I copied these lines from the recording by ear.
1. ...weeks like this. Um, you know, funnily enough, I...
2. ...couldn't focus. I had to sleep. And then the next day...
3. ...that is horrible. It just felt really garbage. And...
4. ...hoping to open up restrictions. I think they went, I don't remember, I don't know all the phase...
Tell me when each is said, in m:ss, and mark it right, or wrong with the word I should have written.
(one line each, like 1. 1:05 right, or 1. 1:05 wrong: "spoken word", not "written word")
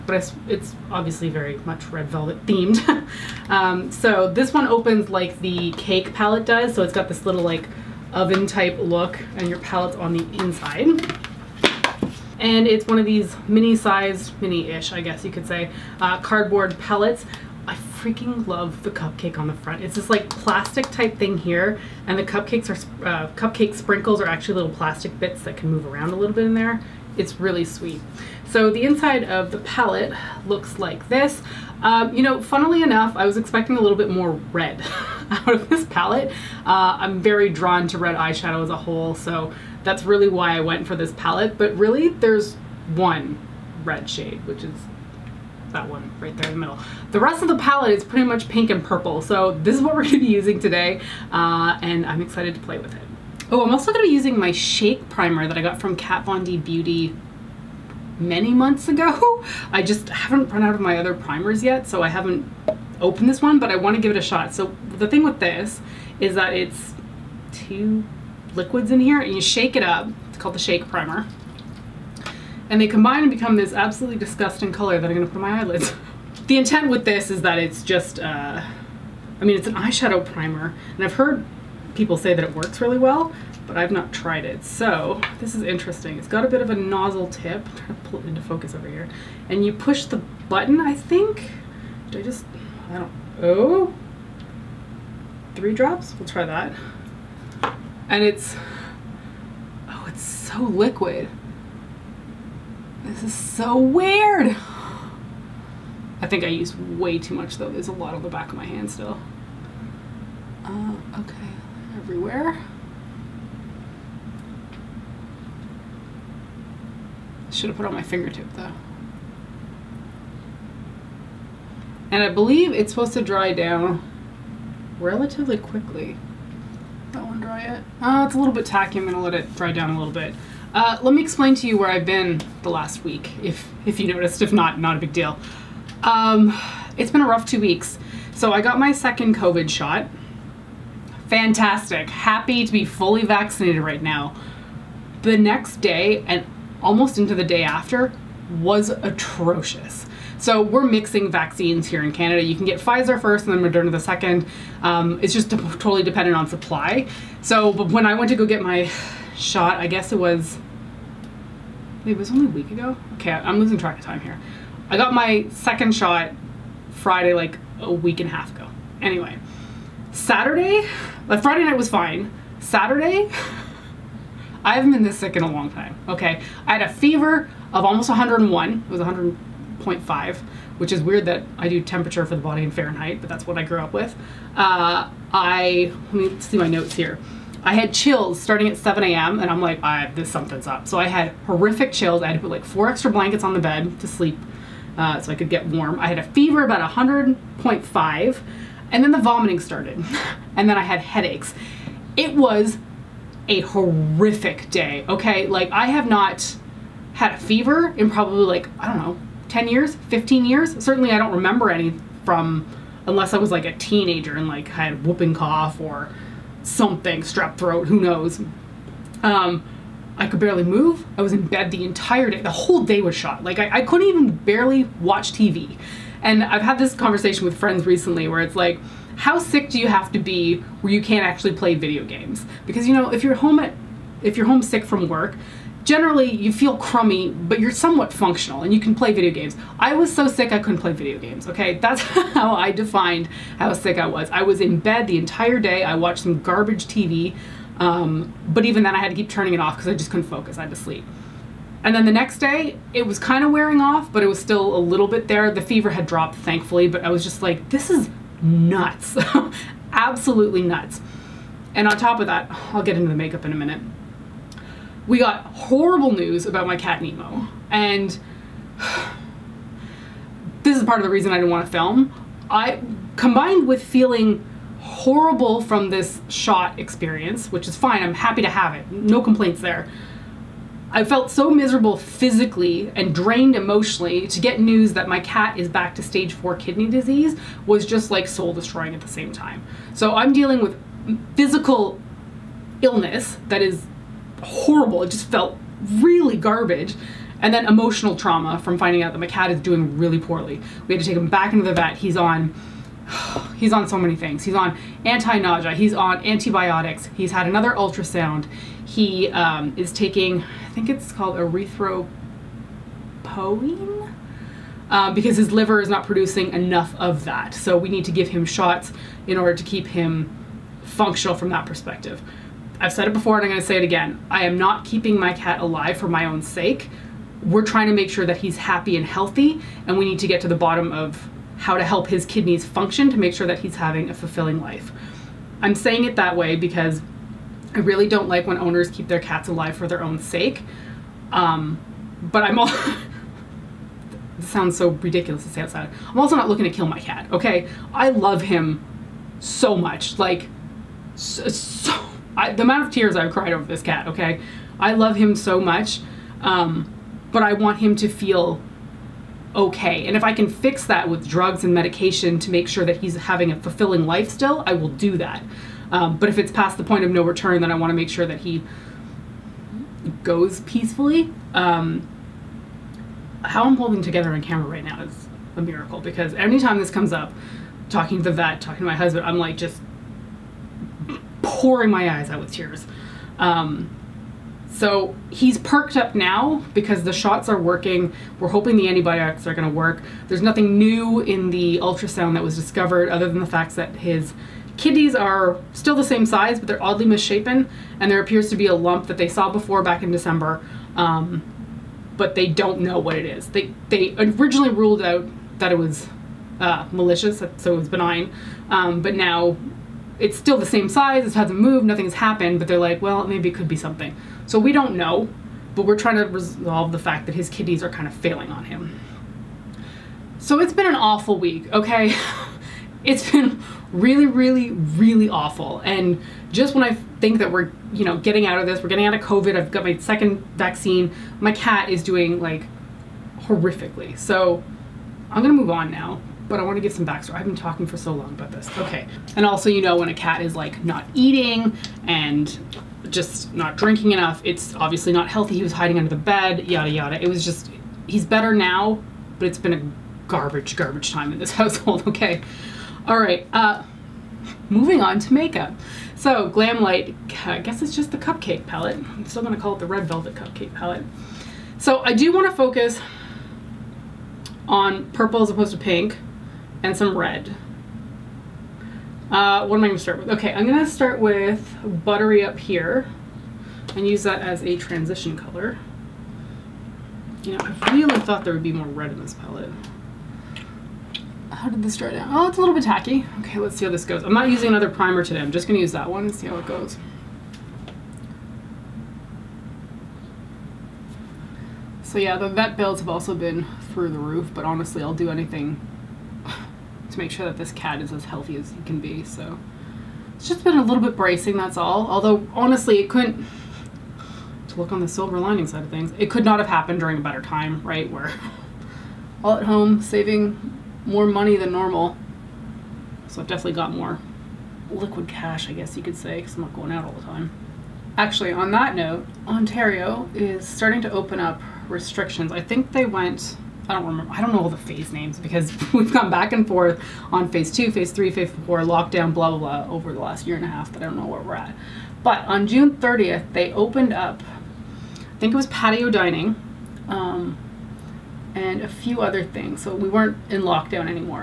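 1. 0:30 wrong: "looks", not "weeks"
2. 4:10 right
3. 4:53 right
4. 8:40 wrong: "starting", not "hoping".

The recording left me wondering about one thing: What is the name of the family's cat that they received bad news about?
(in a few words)
Nemo.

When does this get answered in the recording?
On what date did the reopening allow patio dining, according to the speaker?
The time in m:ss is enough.
8:52.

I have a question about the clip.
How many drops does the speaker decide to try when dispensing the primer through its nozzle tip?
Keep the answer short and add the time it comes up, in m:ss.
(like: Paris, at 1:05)
3, at 1:35.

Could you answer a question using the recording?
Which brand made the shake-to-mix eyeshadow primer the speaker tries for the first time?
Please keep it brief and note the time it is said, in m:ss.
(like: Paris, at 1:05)
Kat Von D Beauty, at 0:55.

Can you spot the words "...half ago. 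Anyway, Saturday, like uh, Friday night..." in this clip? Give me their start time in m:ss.
2:48.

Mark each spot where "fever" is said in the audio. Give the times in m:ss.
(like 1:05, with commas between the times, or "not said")
2:56, 3:16, 3:27, 4:15.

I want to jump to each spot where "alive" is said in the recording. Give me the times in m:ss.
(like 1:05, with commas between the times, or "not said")
5:25, 5:39.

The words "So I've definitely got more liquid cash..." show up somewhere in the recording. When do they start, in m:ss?
8:33.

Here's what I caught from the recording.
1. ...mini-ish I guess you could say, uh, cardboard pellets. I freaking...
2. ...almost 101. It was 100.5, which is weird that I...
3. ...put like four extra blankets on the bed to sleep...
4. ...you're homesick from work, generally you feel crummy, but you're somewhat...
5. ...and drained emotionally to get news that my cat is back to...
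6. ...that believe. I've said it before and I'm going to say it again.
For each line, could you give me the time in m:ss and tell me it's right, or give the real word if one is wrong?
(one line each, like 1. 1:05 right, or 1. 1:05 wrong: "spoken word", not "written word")
1. 0:14 right
2. 2:57 right
3. 3:12 right
4. 3:54 right
5. 4:42 right
6. 5:21 wrong: "perspective", not "believe".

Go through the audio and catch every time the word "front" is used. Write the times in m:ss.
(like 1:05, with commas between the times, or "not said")
0:19.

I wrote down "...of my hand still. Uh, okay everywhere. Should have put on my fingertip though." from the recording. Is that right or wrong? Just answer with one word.
right.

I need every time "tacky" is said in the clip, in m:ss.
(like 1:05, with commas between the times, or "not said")
2:08, 8:02.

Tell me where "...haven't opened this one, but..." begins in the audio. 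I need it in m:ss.
1:02.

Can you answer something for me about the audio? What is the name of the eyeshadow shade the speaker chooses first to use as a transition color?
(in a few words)
Buttery.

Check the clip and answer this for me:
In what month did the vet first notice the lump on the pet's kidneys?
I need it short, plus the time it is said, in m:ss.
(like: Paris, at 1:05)
December, at 6:40.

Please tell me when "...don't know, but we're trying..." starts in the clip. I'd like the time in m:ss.
6:54.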